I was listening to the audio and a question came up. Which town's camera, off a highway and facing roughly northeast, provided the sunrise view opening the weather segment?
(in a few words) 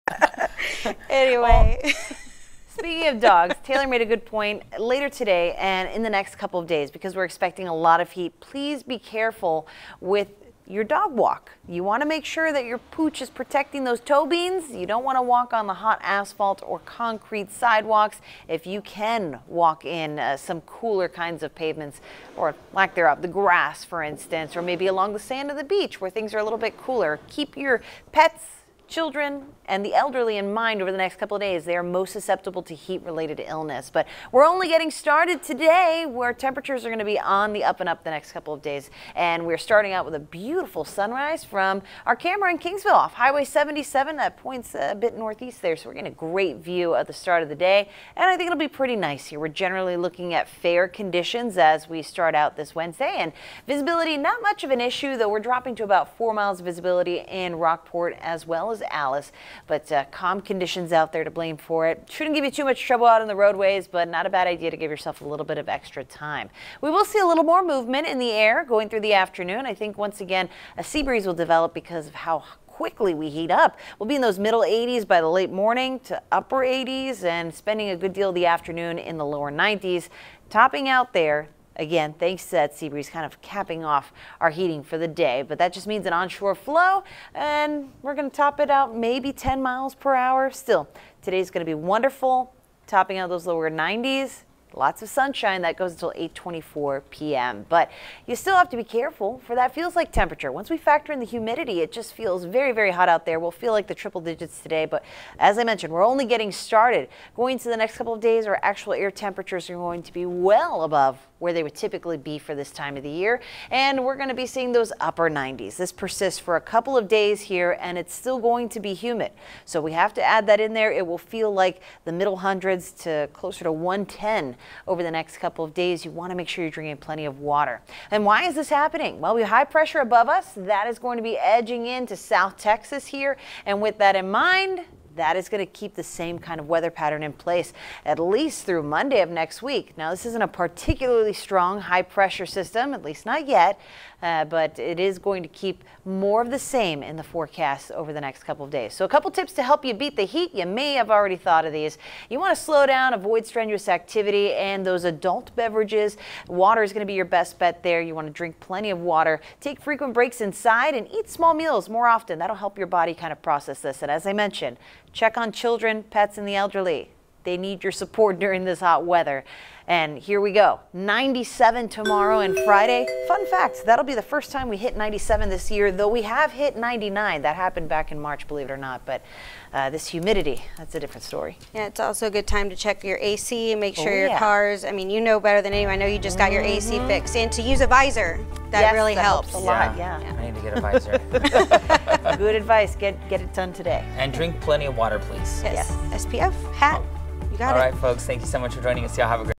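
Kingsville.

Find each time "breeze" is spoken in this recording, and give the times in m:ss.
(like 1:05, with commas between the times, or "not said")
1:11, 1:22.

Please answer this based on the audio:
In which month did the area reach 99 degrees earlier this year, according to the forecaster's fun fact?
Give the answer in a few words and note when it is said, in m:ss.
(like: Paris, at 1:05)
March, at 2:58.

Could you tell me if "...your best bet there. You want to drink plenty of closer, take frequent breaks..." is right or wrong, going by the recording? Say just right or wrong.
wrong.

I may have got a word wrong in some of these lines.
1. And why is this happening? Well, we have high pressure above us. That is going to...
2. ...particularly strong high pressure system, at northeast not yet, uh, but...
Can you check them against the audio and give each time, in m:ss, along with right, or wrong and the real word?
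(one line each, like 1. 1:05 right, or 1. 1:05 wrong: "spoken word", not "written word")
1. 2:08 right
2. 2:20 wrong: "least", not "northeast".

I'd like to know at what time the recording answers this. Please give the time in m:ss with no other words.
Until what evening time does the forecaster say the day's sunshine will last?
1:36.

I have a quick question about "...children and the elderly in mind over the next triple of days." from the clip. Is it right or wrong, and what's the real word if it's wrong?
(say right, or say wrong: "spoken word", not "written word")
wrong: "couple", not "triple".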